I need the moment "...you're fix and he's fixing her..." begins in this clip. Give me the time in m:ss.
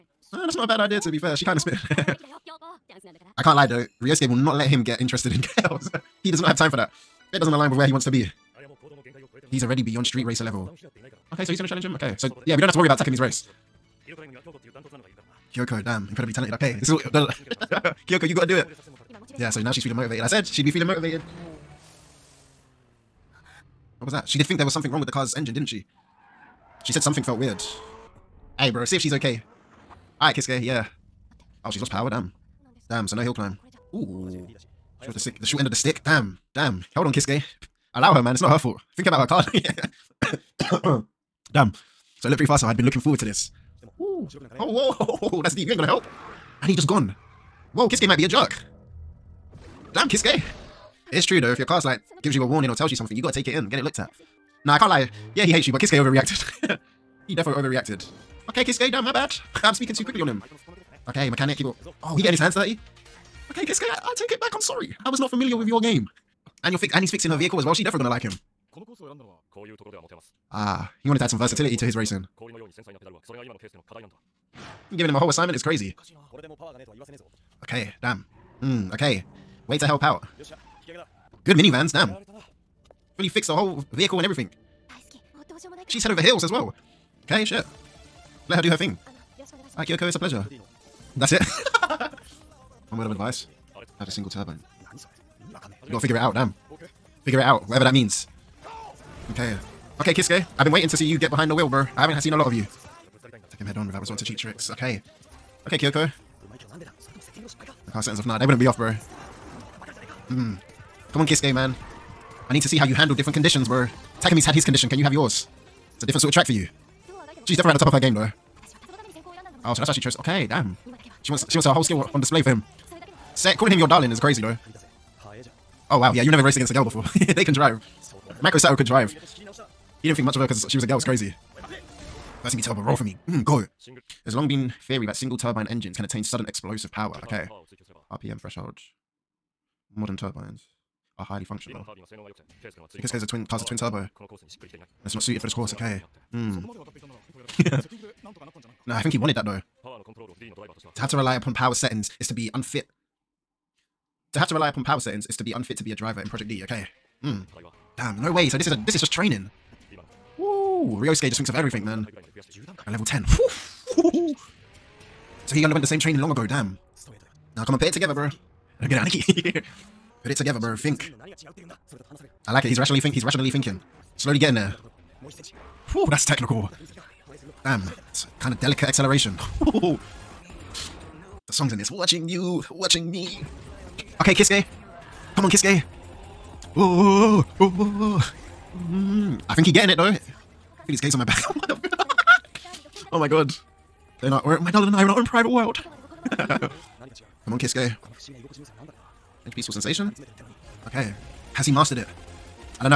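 1:06.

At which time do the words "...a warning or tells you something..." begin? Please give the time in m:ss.
0:52.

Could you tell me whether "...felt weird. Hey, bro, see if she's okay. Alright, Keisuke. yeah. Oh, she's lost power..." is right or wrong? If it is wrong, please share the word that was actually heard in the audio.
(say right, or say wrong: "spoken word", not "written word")
right.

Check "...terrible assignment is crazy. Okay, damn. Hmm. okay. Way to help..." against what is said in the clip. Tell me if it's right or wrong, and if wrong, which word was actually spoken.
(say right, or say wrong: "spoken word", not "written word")
wrong: "whole", not "terrible".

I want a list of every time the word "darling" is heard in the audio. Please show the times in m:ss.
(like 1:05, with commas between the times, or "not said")
2:03, 3:14.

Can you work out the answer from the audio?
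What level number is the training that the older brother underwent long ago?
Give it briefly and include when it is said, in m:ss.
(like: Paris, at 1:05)
10, at 2:42.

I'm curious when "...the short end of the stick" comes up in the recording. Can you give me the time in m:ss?
0:35.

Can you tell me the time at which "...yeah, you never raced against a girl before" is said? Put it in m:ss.
2:06.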